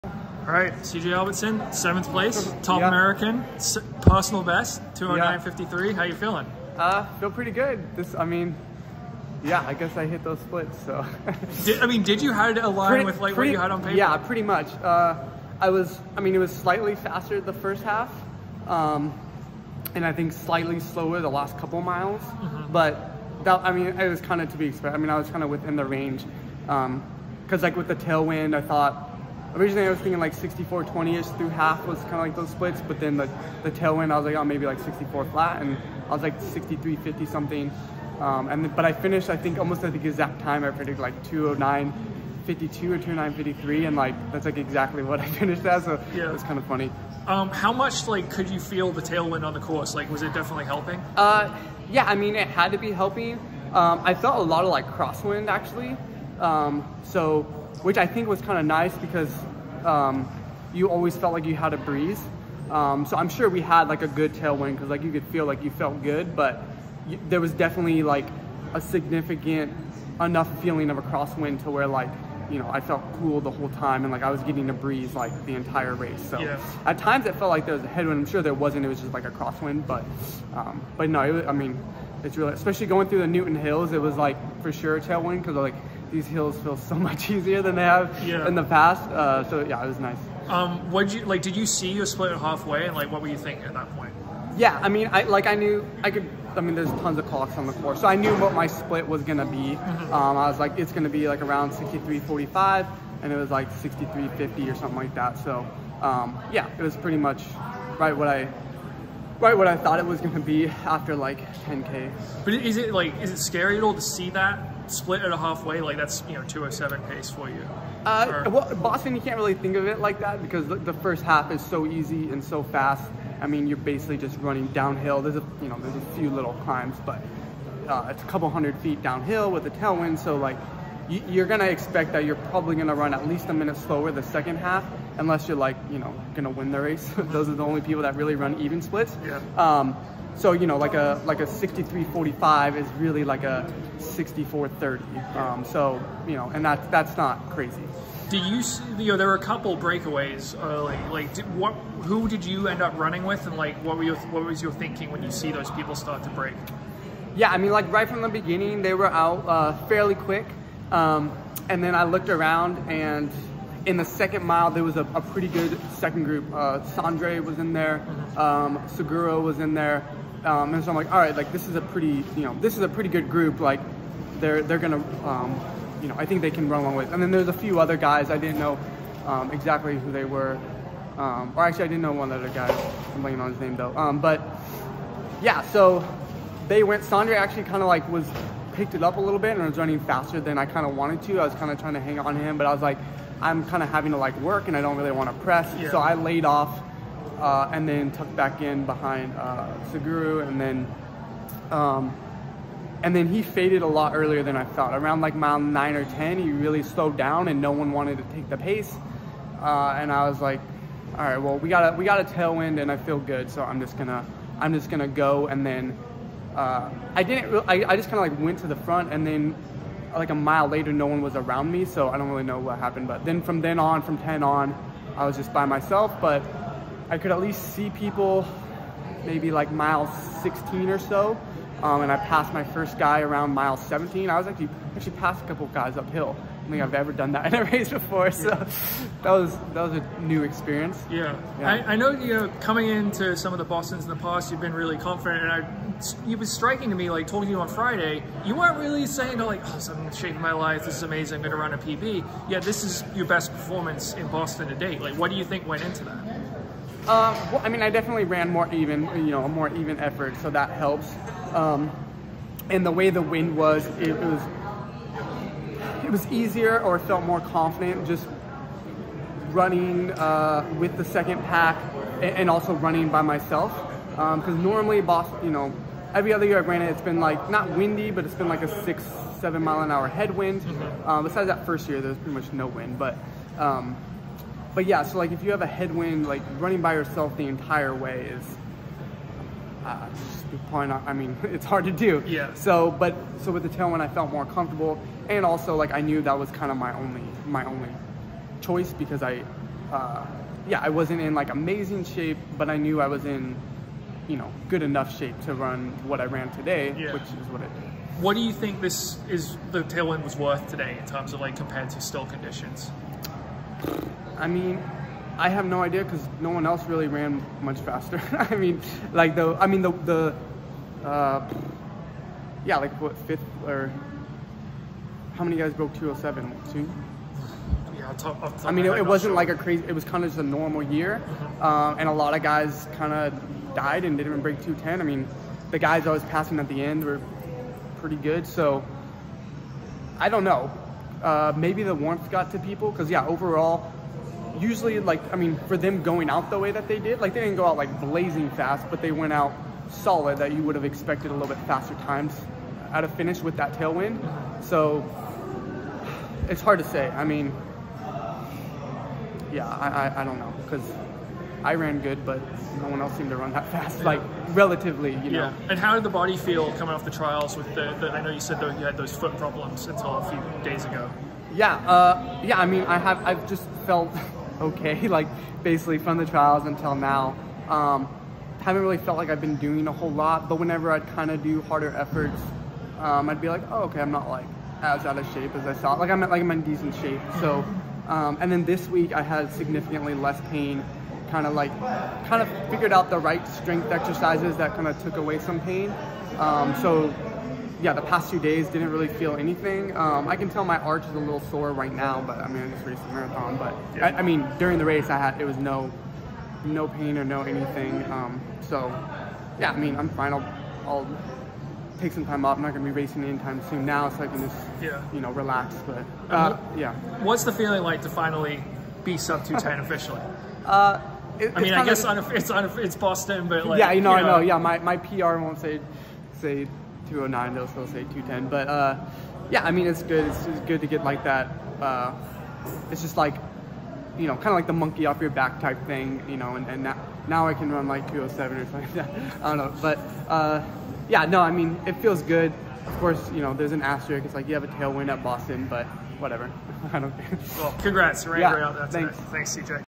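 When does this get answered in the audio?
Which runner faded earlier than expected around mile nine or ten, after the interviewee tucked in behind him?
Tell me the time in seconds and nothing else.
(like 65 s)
199 s.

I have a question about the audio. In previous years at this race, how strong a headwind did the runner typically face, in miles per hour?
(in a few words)
6-7 mph.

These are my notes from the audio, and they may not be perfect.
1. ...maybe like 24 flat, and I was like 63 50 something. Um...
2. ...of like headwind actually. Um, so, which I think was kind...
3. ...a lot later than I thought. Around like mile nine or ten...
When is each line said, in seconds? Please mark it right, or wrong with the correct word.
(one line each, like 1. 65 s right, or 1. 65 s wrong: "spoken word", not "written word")
1. 34 s wrong: "64", not "24"
2. 54 s wrong: "crosswind", not "headwind"
3. 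203 s wrong: "earlier", not "later".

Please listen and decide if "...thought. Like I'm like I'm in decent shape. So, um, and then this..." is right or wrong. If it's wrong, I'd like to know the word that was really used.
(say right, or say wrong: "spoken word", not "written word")
right.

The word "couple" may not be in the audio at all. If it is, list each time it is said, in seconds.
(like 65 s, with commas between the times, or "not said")
21 s, 128 s, 149 s, 235 s.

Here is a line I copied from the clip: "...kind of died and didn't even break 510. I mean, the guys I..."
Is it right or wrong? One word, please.
wrong.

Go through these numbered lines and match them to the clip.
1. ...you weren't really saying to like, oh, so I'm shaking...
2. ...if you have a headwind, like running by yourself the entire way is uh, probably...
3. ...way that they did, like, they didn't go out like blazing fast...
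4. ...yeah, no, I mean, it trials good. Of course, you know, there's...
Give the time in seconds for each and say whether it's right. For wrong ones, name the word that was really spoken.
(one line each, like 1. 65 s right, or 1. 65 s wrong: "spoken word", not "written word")
1. 248 s right
2. 285 s right
3. 346 s right
4. 441 s wrong: "feels", not "trials".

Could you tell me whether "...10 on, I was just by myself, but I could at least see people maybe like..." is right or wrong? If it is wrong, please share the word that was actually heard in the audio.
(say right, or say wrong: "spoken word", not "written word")
right.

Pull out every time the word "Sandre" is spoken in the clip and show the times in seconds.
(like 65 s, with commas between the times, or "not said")
166 s, 187 s.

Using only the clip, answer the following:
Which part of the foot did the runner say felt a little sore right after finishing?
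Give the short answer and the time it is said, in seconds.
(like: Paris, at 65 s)
Arch, at 400 s.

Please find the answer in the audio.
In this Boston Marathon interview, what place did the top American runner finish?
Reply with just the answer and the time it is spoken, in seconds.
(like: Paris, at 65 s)
7th, at 1 s.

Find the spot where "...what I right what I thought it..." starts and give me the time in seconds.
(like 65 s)
108 s.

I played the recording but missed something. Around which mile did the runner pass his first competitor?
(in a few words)
Mile 17.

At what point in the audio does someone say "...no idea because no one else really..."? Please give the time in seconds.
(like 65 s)
315 s.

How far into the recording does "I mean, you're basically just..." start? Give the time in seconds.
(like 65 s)
123 s.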